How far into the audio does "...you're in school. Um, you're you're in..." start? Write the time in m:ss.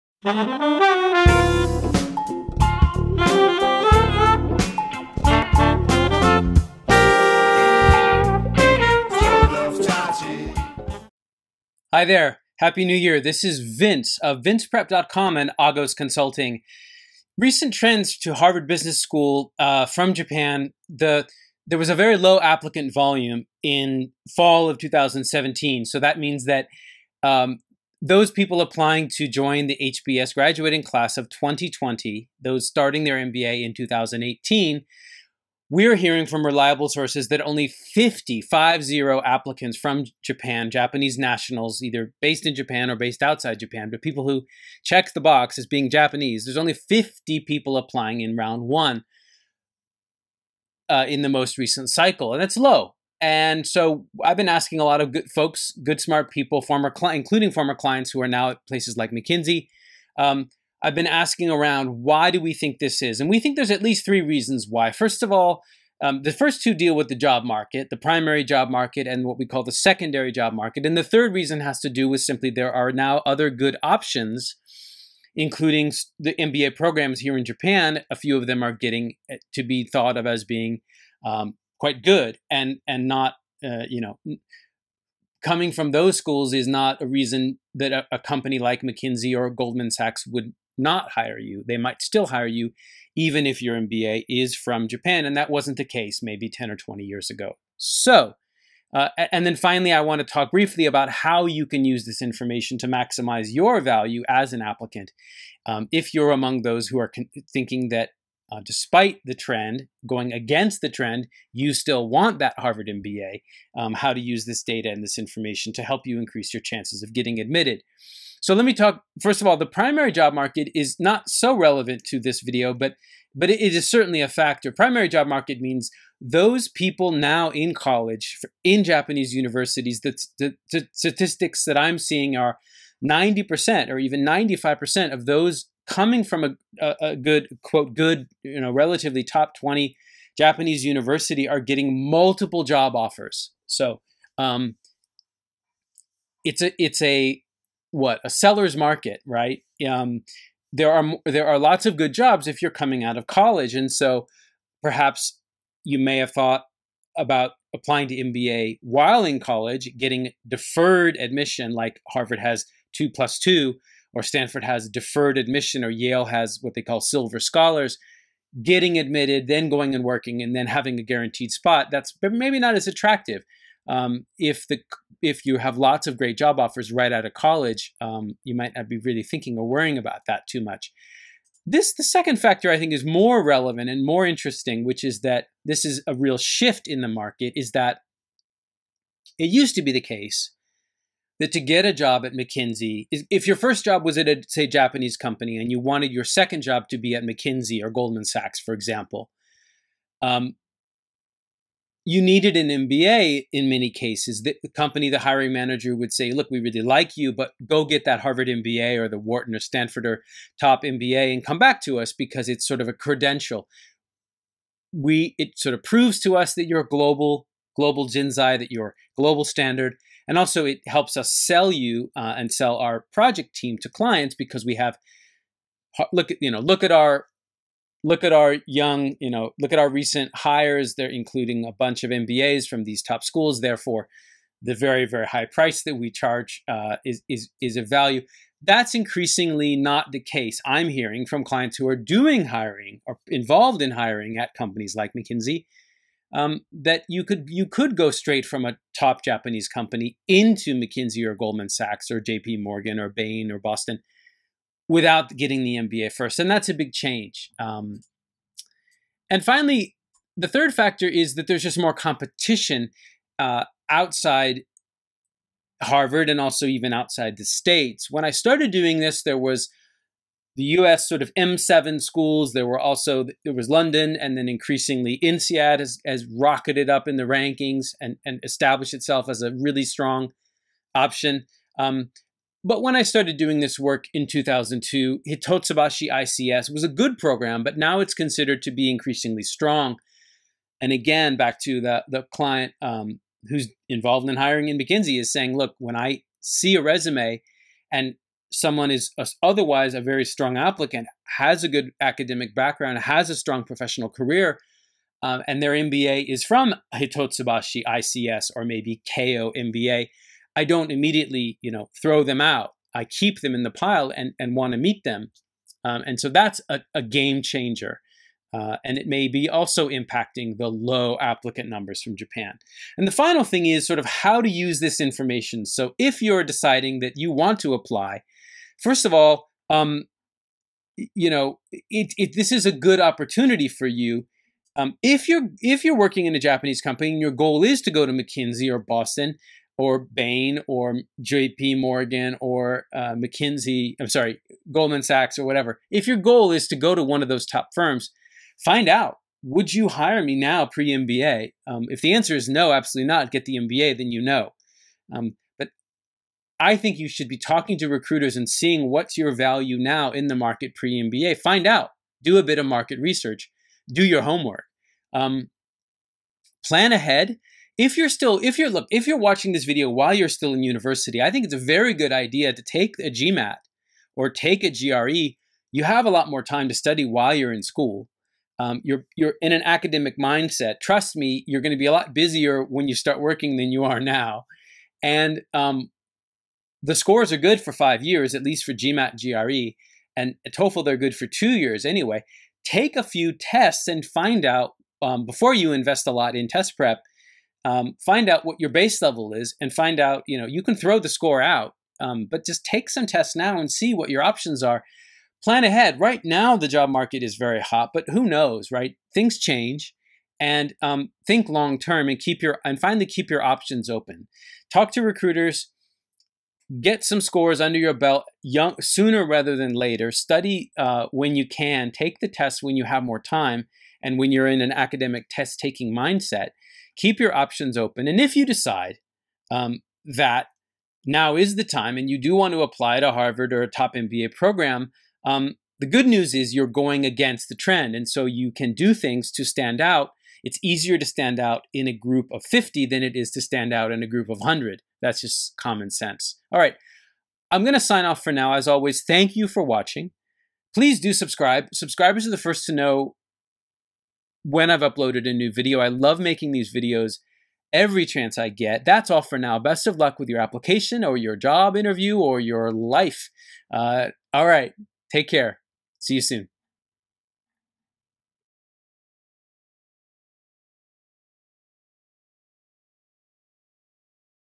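6:17.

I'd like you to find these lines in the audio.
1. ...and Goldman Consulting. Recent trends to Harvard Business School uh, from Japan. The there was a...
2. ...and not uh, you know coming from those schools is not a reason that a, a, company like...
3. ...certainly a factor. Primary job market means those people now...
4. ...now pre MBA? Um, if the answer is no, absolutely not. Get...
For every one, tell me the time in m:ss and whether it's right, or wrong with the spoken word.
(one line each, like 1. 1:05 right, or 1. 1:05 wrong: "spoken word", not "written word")
1. 0:15 wrong: "Agos", not "Goldman"
2. 1:22 right
3. 2:03 right
4. 5:50 right.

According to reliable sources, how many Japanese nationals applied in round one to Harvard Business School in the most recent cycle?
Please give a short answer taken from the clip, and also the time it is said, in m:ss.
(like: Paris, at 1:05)
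50, at 0:46.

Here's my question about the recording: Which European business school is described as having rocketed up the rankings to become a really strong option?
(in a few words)
INSEAD.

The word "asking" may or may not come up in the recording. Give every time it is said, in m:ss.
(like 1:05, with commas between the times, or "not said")
0:54, 1:01.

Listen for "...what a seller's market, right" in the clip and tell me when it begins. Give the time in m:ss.
2:27.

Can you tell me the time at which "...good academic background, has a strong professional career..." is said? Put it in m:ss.
5:01.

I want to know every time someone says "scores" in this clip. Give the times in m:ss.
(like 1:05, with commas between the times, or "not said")
6:26, 6:41, 6:57.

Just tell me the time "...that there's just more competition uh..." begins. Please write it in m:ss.
4:21.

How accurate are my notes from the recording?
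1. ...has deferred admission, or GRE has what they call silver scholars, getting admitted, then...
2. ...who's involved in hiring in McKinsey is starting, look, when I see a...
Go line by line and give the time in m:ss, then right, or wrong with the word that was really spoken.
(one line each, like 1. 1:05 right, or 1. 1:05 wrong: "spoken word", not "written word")
1. 2:44 wrong: "Yale", not "GRE"
2. 4:53 wrong: "saying", not "starting".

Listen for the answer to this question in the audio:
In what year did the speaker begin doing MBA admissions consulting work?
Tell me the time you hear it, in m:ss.
4:44.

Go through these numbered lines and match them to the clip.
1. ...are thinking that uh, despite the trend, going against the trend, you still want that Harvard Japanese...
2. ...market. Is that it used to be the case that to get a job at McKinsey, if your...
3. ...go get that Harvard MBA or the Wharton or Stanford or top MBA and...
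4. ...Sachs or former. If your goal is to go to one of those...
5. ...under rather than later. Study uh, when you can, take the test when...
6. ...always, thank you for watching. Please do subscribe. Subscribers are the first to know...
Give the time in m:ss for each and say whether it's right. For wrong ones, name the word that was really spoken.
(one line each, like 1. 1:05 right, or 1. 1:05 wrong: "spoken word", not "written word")
1. 1:46 wrong: "MBA", not "Japanese"
2. 3:07 right
3. 3:27 right
4. 5:45 wrong: "whatever", not "former"
5. 6:58 wrong: "sooner", not "under"
6. 7:28 right.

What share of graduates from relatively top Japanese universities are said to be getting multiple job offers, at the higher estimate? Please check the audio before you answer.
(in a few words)
95%.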